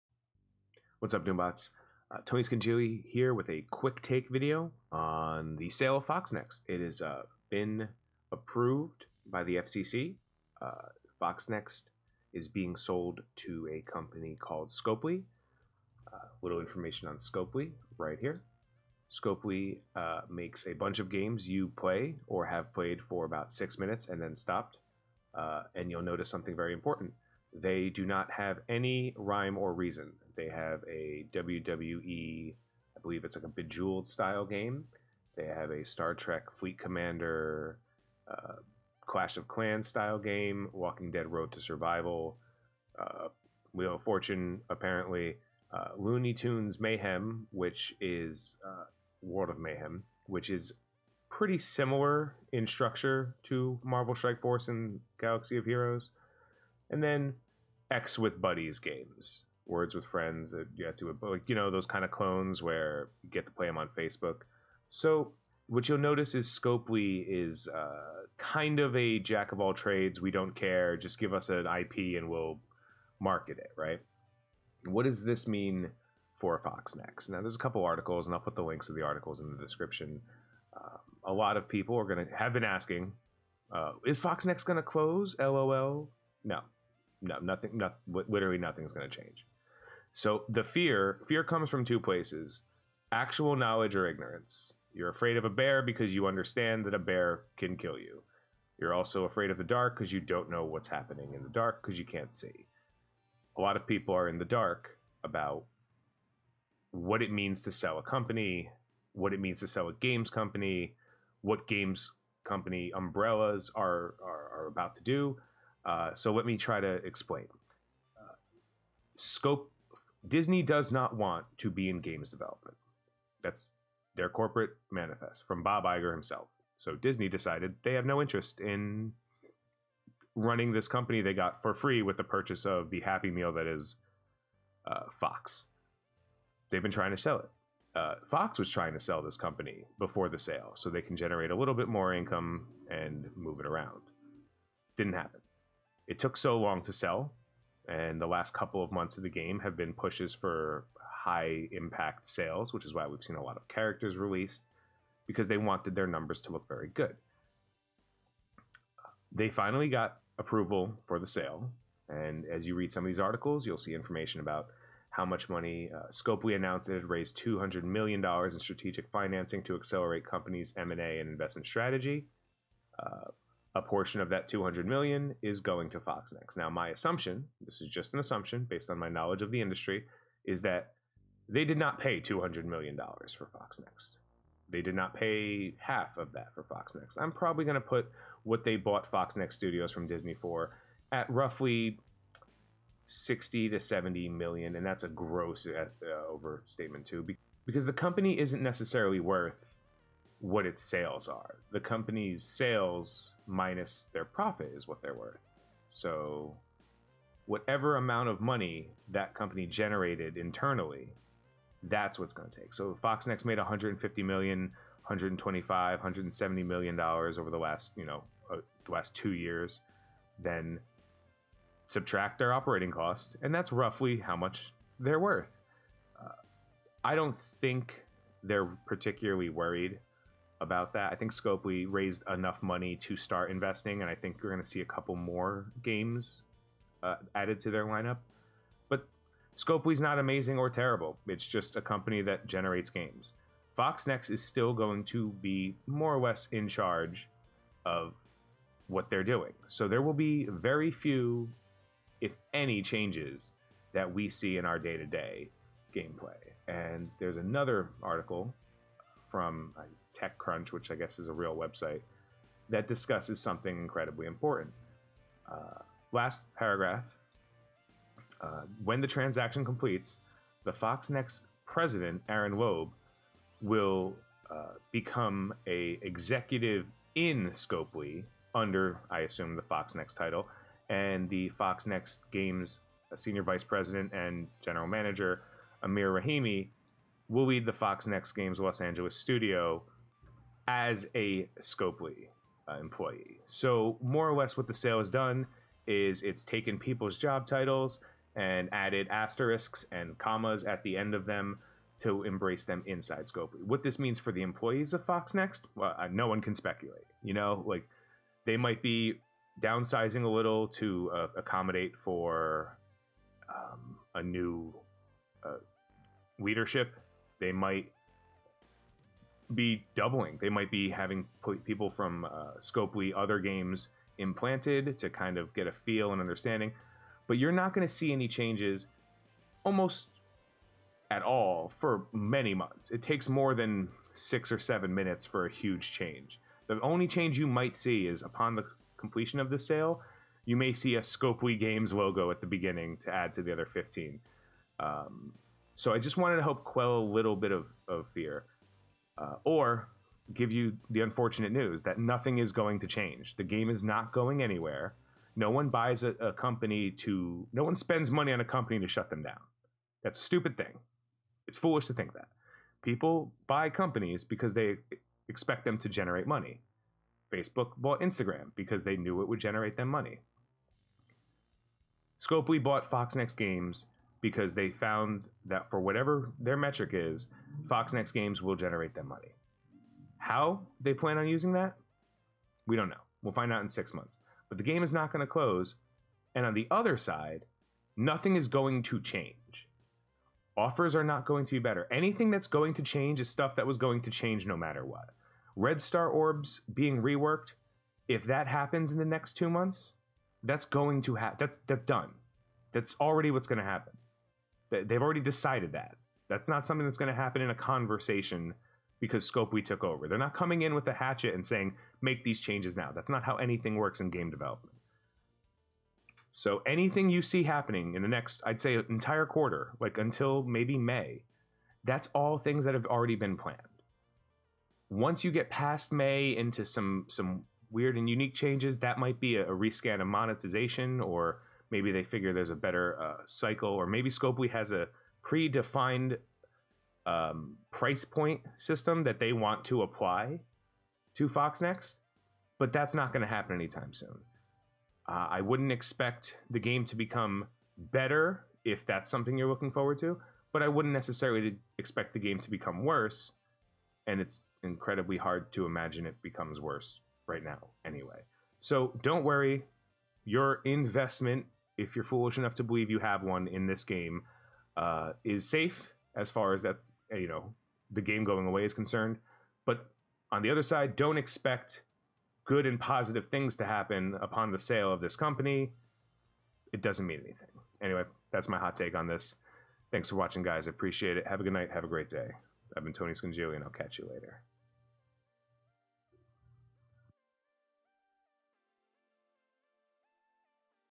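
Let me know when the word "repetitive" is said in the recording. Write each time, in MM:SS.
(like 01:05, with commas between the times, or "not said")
not said.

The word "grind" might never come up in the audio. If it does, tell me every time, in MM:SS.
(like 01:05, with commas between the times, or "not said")
not said.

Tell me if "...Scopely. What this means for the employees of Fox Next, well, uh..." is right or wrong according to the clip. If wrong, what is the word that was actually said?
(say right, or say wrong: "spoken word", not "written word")
right.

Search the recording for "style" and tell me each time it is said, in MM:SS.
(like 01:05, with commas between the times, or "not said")
00:34, 00:39.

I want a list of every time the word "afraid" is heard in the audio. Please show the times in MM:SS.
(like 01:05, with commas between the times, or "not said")
01:35, 01:39.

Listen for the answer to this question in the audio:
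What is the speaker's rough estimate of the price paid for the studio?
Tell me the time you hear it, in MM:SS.
03:13.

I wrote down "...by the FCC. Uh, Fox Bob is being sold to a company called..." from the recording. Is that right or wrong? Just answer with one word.
wrong.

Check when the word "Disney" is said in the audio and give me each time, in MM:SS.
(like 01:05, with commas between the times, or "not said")
02:00, 02:06, 03:10.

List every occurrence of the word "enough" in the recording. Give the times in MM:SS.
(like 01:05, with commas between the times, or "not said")
03:52, 07:42.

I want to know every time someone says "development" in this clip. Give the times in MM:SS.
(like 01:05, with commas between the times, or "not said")
02:02, 06:54.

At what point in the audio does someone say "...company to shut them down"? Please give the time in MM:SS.
05:58.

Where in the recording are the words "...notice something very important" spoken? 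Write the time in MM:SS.
00:26.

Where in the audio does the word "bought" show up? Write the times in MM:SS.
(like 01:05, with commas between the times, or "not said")
03:08, 06:07, 06:12.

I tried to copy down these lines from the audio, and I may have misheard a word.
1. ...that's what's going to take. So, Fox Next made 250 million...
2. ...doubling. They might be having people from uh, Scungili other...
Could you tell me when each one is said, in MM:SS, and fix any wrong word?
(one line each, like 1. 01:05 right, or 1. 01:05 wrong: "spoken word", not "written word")
1. 03:31 wrong: "150", not "250"
2. 05:19 wrong: "Scopely", not "Scungili".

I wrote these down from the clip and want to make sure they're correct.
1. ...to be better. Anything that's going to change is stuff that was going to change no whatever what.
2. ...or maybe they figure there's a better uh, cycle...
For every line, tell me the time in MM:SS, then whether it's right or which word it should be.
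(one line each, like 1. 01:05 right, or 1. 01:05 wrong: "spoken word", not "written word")
1. 06:31 wrong: "matter", not "whatever"
2. 07:11 right.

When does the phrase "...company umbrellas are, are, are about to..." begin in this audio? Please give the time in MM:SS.
01:52.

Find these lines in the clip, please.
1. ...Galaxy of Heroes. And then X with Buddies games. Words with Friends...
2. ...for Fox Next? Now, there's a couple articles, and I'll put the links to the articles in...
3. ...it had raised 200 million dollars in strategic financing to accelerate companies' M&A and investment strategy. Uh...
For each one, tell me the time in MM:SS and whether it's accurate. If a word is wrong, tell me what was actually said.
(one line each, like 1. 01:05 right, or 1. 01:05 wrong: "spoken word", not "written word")
1. 00:55 right
2. 01:16 right
3. 02:46 right.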